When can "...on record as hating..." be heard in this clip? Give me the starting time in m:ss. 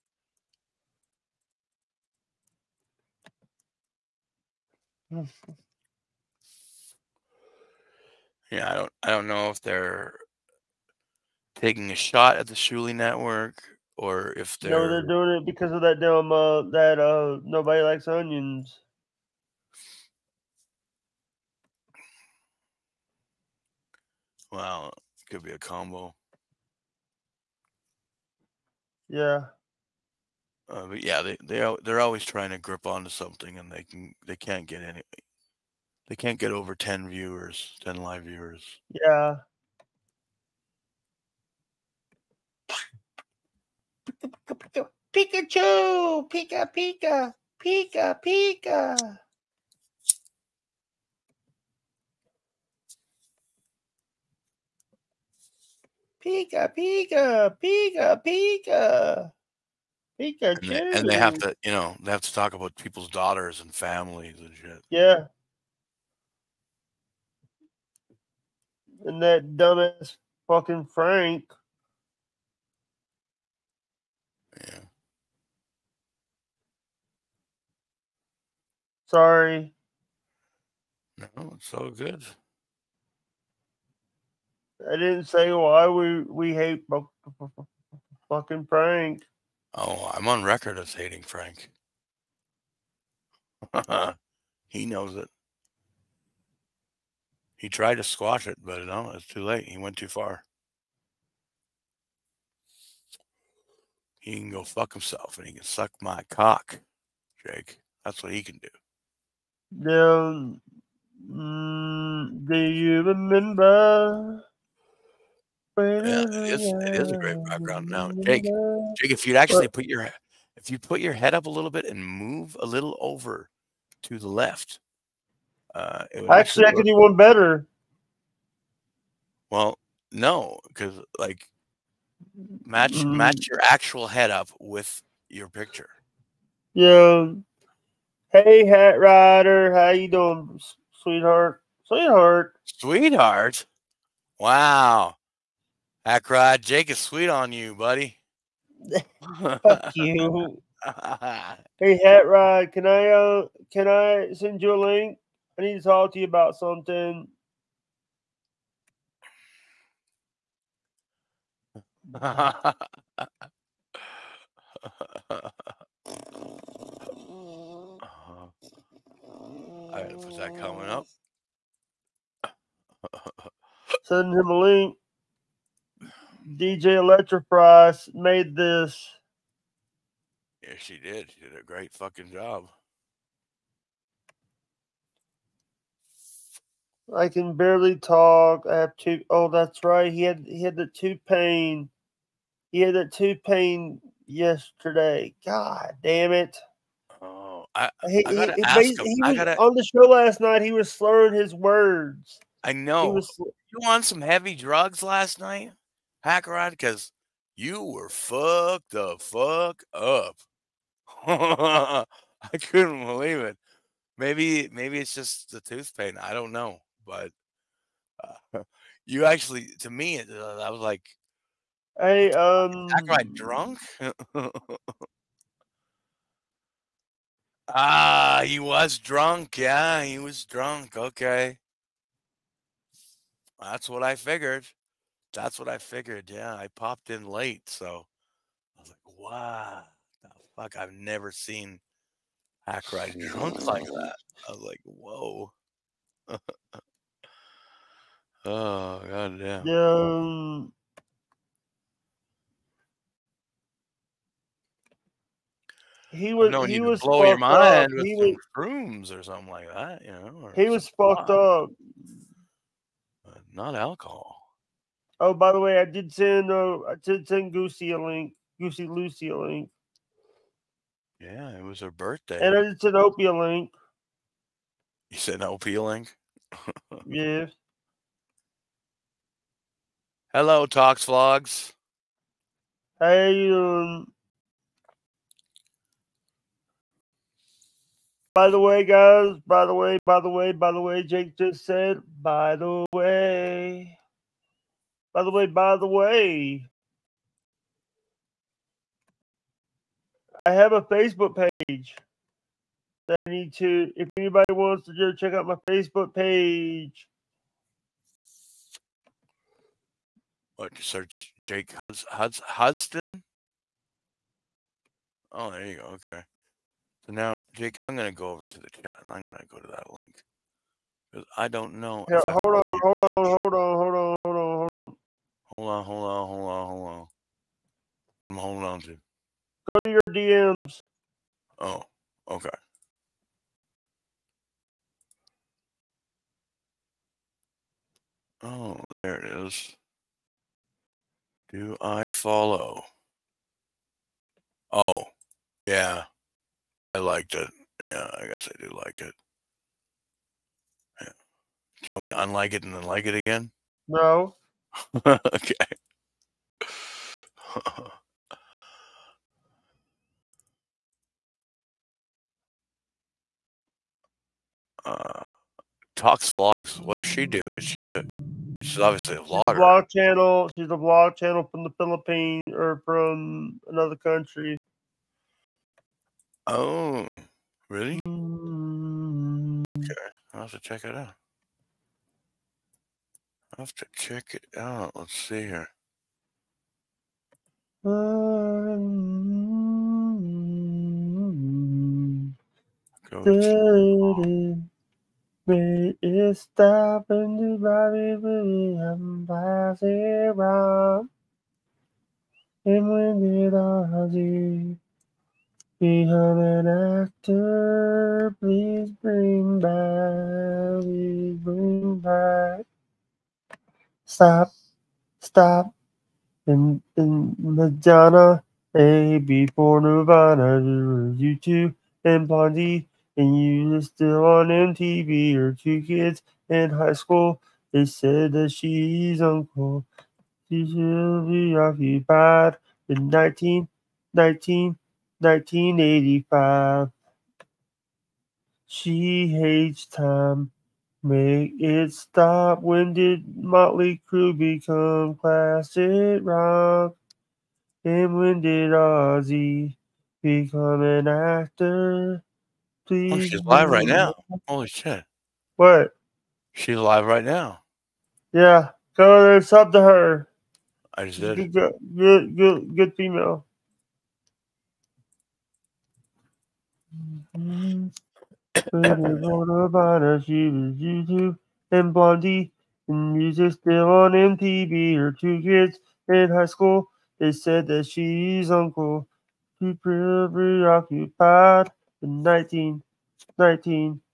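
1:30.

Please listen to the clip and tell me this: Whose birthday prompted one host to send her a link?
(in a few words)
Goosey Lucy.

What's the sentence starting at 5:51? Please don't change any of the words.
Do you want me to unlike it and then like it again?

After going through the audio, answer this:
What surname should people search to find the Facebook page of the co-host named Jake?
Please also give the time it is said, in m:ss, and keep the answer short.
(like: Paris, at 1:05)
Hudson, at 5:12.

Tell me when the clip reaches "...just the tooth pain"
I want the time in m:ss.
3:35.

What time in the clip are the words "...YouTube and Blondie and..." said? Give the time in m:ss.
7:50.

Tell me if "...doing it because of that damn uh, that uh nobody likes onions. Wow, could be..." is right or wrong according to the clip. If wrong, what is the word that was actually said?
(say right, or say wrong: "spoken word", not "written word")
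right.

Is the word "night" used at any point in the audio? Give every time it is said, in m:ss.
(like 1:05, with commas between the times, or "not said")
3:20, 3:25.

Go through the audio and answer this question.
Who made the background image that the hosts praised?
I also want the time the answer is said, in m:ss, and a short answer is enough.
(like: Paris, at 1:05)
DJ Electra, at 2:56.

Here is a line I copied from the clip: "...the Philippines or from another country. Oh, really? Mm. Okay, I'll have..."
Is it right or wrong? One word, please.
right.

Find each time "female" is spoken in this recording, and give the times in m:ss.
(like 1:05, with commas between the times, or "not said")
7:42.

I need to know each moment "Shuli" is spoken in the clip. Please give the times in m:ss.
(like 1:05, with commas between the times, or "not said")
0:12.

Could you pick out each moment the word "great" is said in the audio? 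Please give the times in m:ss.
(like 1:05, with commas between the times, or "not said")
1:57, 3:01.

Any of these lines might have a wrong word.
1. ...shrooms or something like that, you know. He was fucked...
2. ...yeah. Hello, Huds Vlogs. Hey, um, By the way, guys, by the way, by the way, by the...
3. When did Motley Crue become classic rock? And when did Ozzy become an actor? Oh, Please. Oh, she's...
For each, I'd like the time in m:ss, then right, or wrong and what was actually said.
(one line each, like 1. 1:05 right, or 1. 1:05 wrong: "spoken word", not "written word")
1. 4:18 right
2. 4:37 wrong: "Talks", not "Huds"
3. 7:22 right.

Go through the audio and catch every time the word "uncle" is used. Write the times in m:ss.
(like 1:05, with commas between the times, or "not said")
7:09, 7:58.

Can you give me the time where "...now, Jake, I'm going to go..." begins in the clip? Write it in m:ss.
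5:17.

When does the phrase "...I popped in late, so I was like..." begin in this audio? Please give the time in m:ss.
3:56.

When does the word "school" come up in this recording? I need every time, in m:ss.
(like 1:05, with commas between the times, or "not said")
7:06, 7:56.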